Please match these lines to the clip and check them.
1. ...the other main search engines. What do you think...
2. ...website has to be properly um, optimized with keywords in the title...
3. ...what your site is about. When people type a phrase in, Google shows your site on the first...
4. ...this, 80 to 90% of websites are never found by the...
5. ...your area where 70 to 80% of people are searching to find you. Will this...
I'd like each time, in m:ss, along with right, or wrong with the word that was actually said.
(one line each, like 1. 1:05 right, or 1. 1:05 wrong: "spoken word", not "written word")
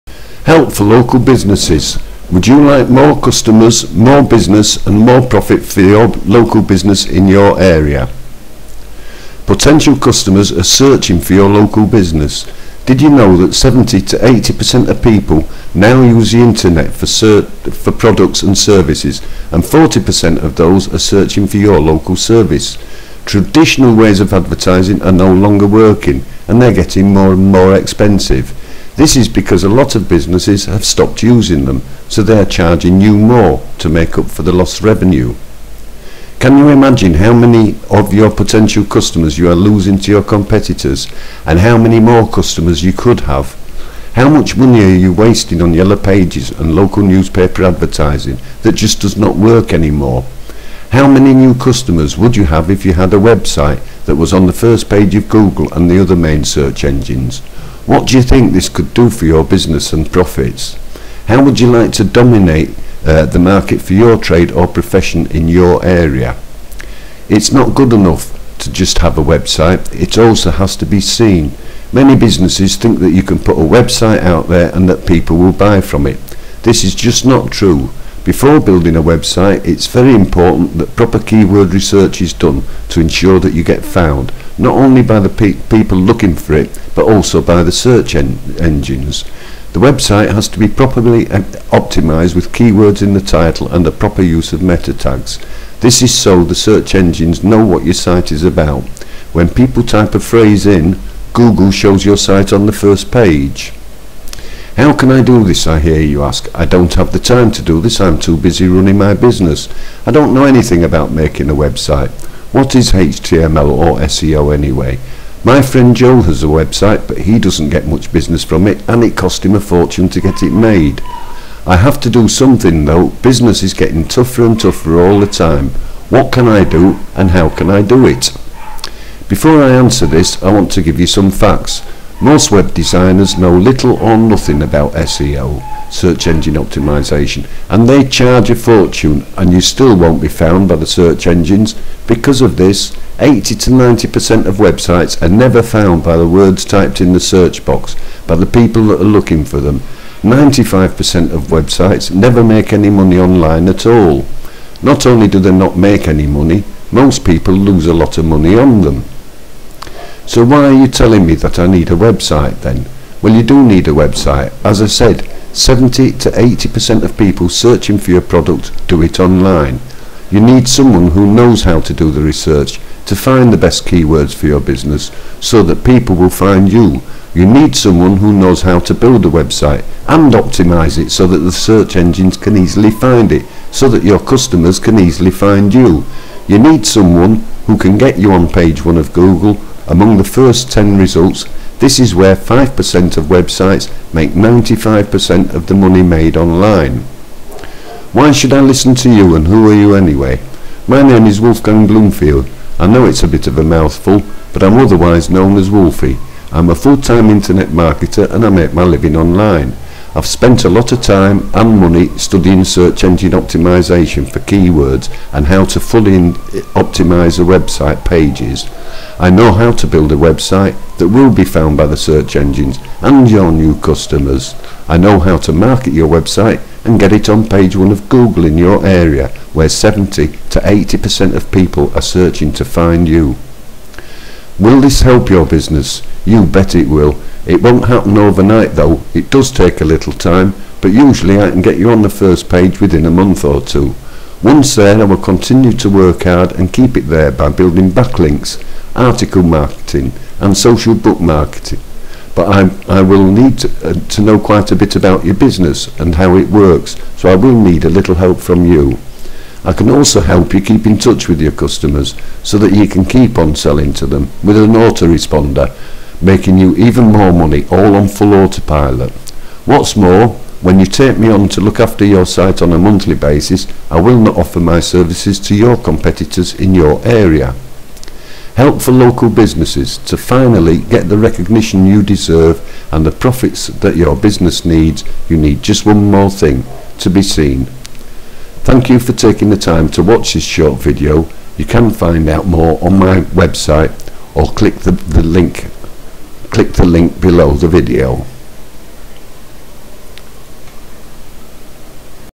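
1. 0:55 right
2. 1:29 right
3. 1:37 right
4. 2:22 right
5. 3:48 right.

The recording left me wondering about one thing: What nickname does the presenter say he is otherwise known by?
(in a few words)
Wolfie.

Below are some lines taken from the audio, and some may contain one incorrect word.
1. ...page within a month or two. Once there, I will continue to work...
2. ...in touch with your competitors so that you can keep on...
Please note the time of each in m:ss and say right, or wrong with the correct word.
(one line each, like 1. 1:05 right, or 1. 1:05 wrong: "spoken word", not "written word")
1. 4:02 right
2. 4:20 wrong: "customers", not "competitors".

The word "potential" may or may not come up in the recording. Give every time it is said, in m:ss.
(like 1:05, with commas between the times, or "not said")
0:09, 0:38.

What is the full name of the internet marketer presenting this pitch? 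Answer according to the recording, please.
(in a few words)
Wolfgang Bloomfield.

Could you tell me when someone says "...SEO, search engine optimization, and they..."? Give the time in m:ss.
2:14.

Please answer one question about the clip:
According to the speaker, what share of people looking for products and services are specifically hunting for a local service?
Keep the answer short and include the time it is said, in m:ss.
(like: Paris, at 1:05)
40%, at 0:19.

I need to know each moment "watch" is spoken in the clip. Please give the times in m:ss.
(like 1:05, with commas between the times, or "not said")
4:50.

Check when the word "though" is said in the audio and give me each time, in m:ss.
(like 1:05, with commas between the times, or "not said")
2:02, 3:58.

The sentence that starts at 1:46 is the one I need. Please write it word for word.
I don't have the time to do this, I'm too busy running my business.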